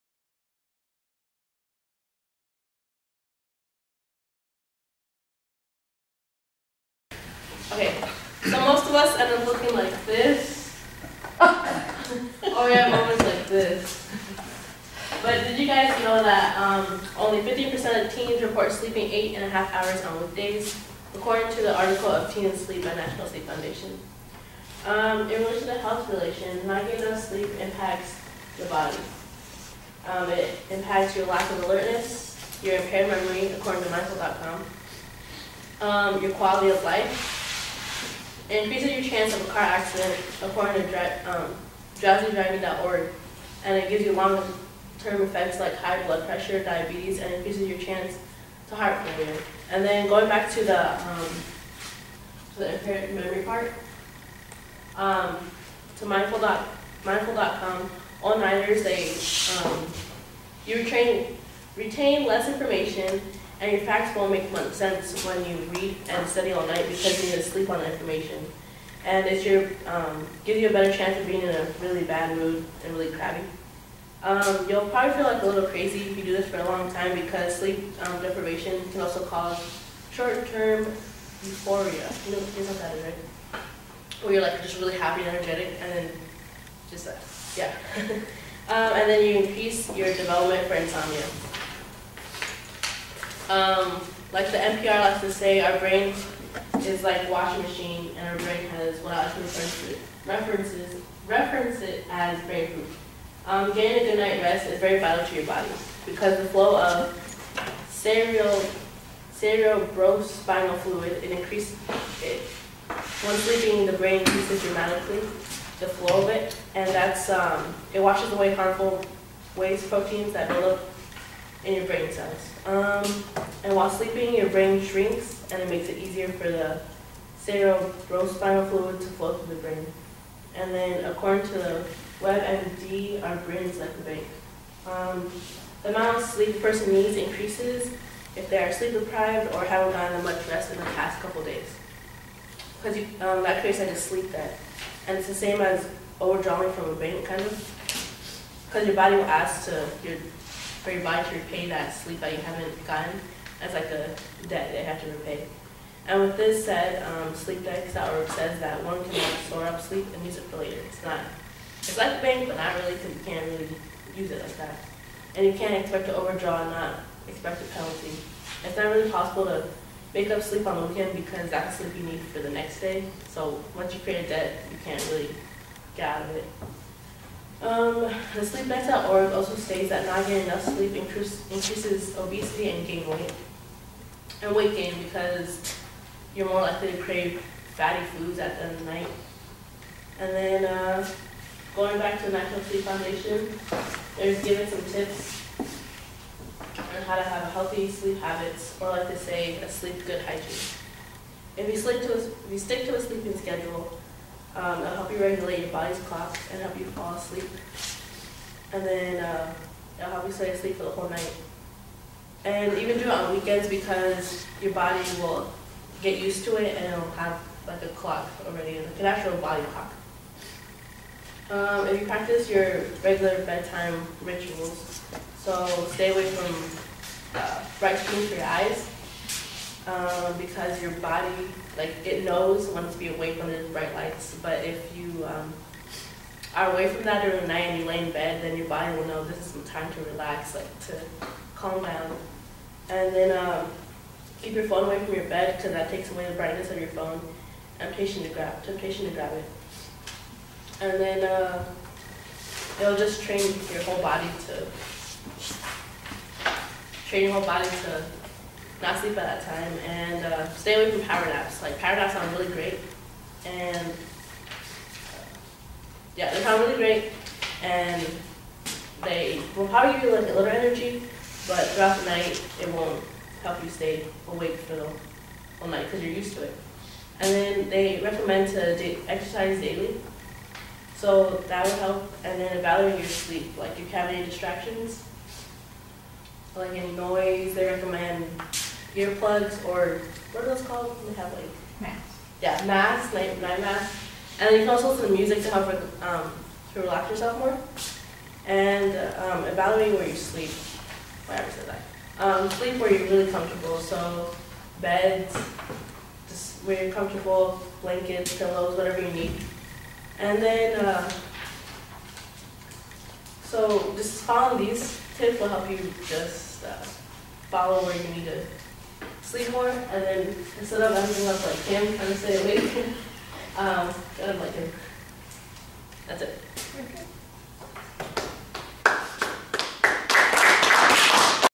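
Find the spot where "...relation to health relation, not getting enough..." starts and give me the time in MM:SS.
00:25.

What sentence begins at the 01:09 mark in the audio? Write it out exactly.
And it's your um, gives you a better chance of being in a really bad mood and really crabby.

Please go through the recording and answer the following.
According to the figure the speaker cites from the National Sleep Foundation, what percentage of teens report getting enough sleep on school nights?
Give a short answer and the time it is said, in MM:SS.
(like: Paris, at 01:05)
50%, at 00:17.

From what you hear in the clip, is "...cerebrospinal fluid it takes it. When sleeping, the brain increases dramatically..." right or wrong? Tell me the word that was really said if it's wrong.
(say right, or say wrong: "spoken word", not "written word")
wrong: "increases", not "takes".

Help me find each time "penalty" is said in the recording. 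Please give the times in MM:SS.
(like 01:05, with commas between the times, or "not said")
02:47.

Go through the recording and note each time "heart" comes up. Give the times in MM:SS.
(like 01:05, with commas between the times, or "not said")
00:48.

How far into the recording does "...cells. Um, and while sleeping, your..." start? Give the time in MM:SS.
02:02.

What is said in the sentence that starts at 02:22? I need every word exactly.
Because um, that creates like a sleep debt.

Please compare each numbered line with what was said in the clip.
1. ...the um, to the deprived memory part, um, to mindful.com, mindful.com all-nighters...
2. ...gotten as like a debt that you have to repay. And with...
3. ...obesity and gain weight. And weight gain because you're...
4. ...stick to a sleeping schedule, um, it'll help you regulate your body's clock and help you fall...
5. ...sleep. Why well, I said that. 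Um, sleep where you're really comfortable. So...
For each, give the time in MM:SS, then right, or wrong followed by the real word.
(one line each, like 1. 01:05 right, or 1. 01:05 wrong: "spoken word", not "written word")
1. 00:50 wrong: "impaired", not "deprived"
2. 02:32 right
3. 03:02 right
4. 03:22 right
5. 05:00 right.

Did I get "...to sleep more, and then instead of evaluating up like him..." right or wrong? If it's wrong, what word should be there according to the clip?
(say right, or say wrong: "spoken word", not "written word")
wrong: "ending", not "evaluating".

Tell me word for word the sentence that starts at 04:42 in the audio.
And then evaluating your sleep, like if you have any distractions, like any noise, they recommend earplugs or what are those called?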